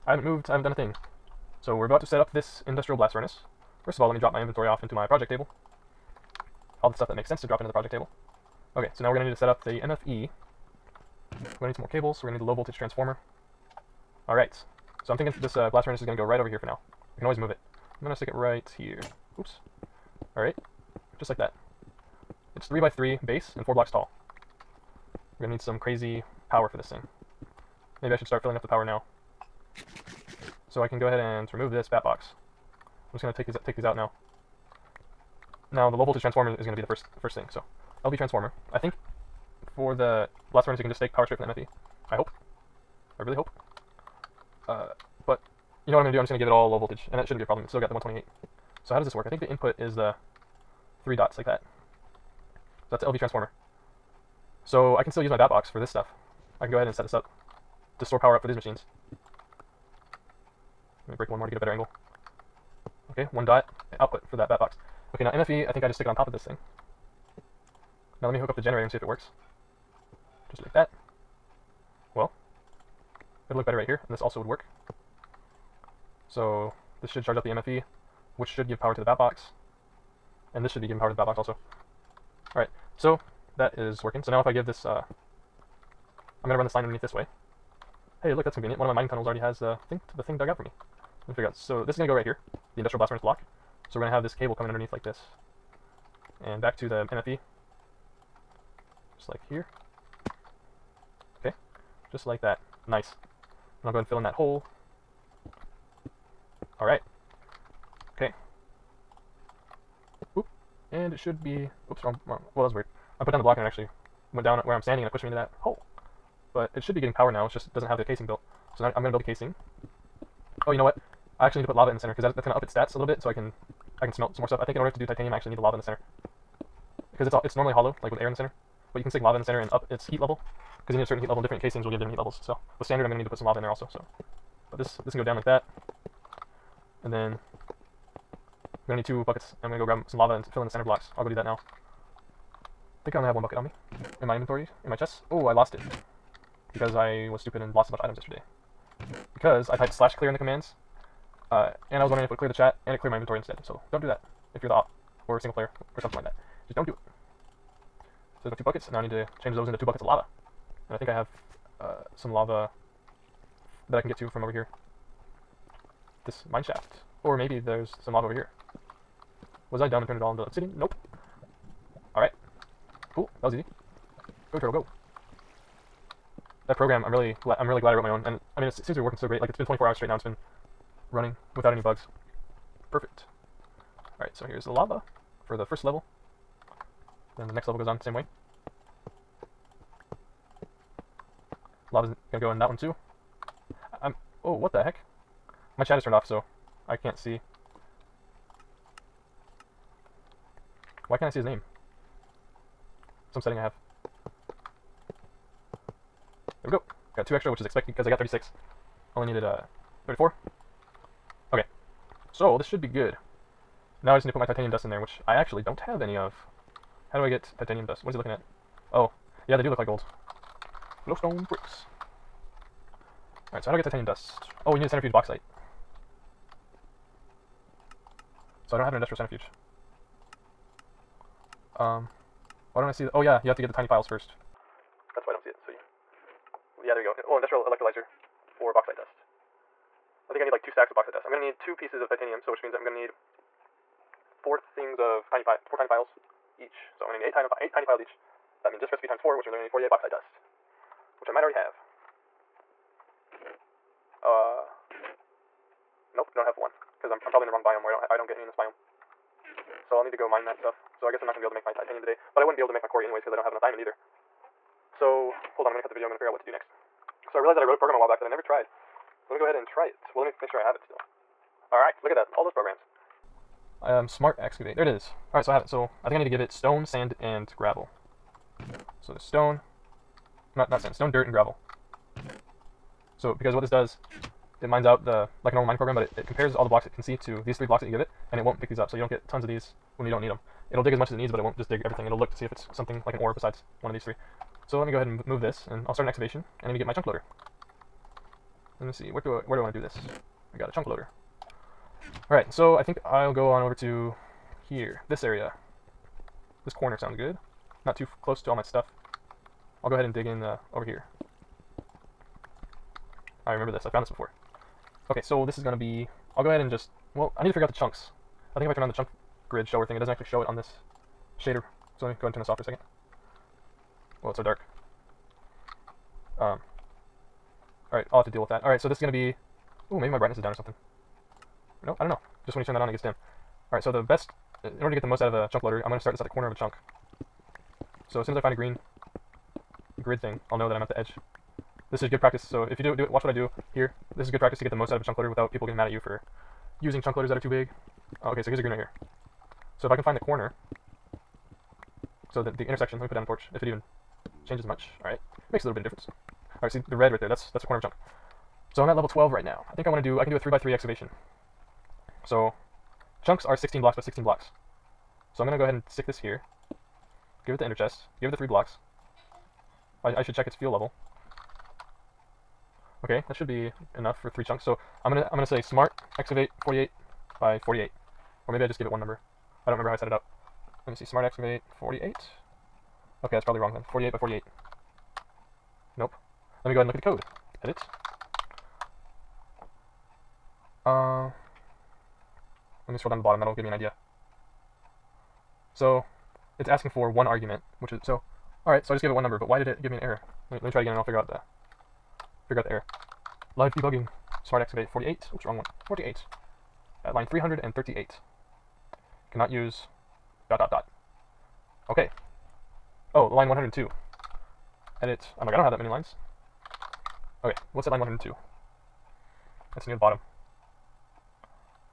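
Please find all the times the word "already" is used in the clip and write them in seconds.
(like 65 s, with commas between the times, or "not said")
89 s, 251 s.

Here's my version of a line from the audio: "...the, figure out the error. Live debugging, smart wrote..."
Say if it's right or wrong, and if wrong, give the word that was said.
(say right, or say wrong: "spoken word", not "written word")
wrong: "activate", not "wrote".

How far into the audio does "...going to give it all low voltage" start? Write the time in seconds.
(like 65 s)
46 s.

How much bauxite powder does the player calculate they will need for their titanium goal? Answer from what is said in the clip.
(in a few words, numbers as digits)
48.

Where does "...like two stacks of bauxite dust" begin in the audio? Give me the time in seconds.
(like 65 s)
240 s.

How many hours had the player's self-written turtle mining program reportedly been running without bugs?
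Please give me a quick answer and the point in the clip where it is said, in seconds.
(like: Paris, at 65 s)
24, at 179 s.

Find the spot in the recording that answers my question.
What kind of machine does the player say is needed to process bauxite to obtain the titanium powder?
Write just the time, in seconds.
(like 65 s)
228 s.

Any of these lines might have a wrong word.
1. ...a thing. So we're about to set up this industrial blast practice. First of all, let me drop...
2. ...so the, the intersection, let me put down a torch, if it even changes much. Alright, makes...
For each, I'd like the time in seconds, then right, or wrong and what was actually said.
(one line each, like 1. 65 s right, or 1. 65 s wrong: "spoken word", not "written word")
1. 0 s wrong: "furnace", not "practice"
2. 352 s right.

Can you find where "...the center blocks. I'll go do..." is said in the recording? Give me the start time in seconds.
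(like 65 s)
140 s.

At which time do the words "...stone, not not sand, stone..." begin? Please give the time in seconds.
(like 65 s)
279 s.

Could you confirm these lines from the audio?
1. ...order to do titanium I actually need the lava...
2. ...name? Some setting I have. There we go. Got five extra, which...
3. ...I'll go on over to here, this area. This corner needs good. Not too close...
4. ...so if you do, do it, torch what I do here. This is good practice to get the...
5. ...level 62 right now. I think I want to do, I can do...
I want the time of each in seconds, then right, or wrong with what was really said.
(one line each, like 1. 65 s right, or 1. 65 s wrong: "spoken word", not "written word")
1. 124 s right
2. 201 s wrong: "two", not "five"
3. 303 s wrong: "sounds", not "needs"
4. 342 s wrong: "watch", not "torch"
5. 358 s wrong: "12", not "62".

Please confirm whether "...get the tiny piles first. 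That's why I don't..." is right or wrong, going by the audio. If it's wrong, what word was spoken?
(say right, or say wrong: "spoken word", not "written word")
right.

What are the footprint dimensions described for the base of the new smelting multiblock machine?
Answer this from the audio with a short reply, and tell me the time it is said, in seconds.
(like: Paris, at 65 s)
3 by 3, at 22 s.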